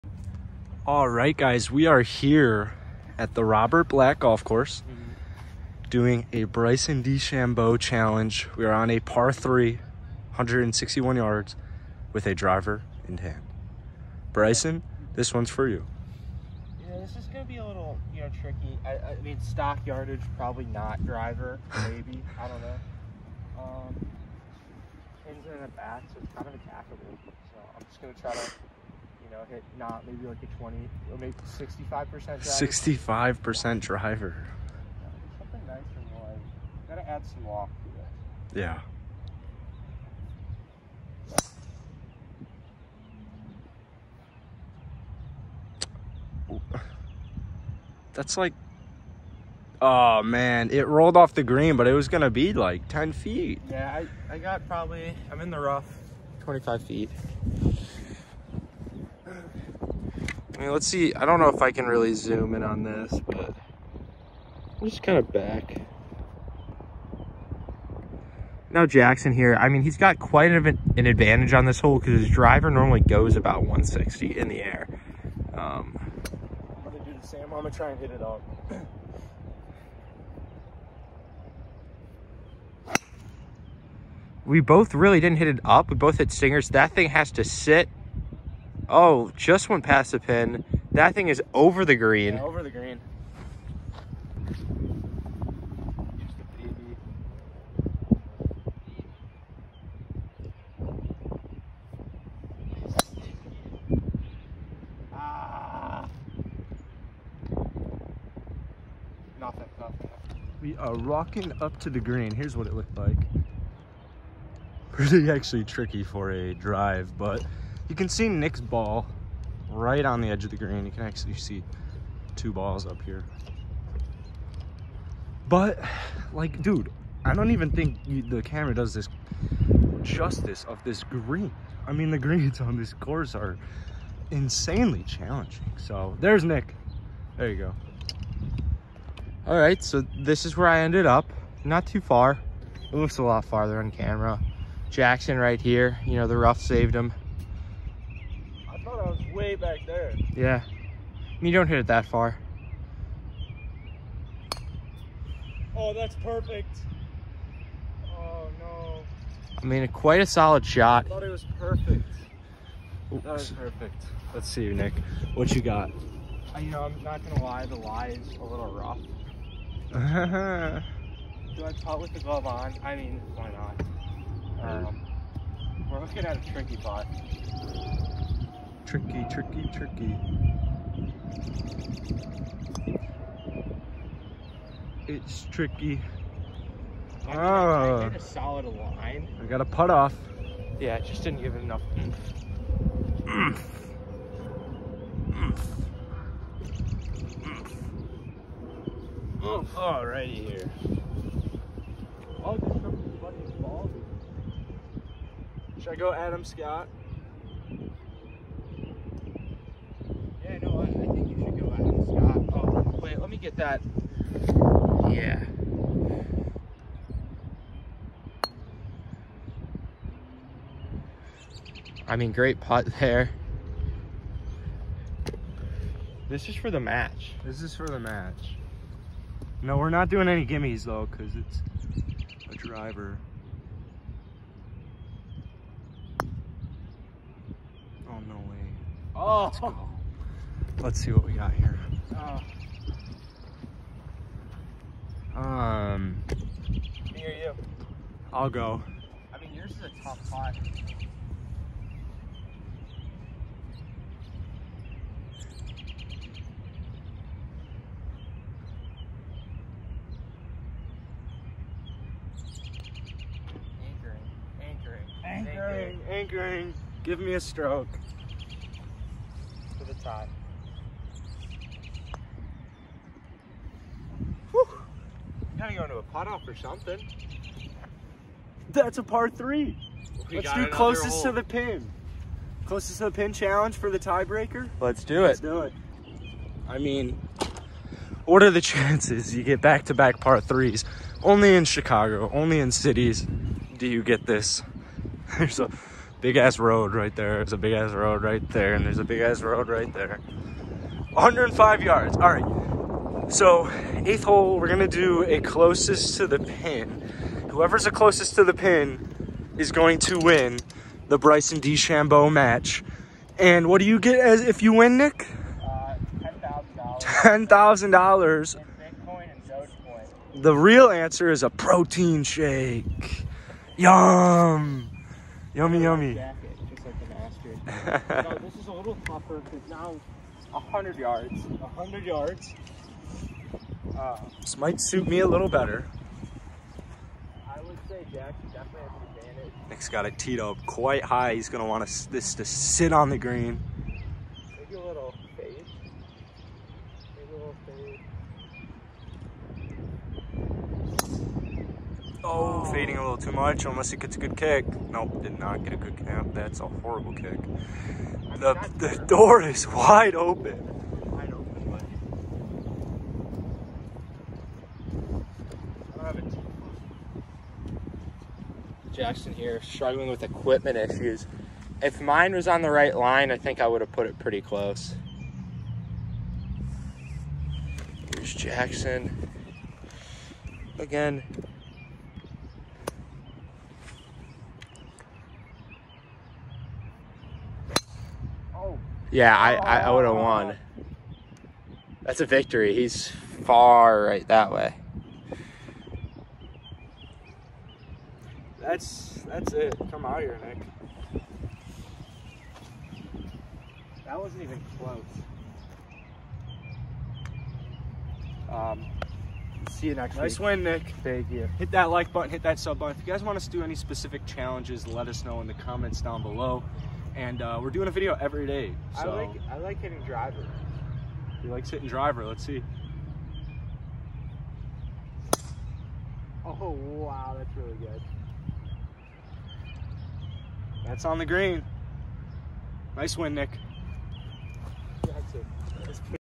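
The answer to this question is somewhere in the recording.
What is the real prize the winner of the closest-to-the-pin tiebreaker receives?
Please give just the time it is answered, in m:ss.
5:21.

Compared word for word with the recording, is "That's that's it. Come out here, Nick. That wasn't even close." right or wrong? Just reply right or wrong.
right.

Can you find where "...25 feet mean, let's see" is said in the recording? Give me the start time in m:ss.
0:56.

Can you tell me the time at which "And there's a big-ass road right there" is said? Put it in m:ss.
4:58.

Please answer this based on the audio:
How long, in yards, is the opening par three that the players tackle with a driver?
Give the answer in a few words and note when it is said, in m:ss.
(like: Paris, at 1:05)
161 yards, at 0:10.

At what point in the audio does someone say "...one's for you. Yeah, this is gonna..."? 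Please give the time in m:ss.
0:15.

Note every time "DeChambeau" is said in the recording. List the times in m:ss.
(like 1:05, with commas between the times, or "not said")
0:07, 5:11.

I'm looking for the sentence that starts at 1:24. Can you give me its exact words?
we both really didn't hit it up.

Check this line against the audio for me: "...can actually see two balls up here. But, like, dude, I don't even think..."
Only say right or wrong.
right.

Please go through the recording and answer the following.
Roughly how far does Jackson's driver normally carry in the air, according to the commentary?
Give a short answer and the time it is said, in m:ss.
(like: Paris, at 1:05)
160, at 1:13.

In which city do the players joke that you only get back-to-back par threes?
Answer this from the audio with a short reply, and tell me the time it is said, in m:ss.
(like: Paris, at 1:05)
Chicago, at 4:51.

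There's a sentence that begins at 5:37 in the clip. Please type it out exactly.
I would say Jack definitely has an advantage.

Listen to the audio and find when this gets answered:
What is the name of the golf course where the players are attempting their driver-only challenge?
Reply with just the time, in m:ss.
0:03.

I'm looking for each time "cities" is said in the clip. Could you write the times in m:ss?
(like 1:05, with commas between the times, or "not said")
4:52.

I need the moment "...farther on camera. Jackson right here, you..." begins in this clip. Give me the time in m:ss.
2:23.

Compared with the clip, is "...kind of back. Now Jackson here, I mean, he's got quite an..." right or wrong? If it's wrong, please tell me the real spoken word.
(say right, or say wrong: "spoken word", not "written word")
right.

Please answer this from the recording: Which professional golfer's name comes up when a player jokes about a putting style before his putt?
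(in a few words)
Adam Scott.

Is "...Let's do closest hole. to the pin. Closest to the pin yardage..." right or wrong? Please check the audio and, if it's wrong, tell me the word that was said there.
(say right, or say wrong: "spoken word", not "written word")
wrong: "challenge", not "yardage".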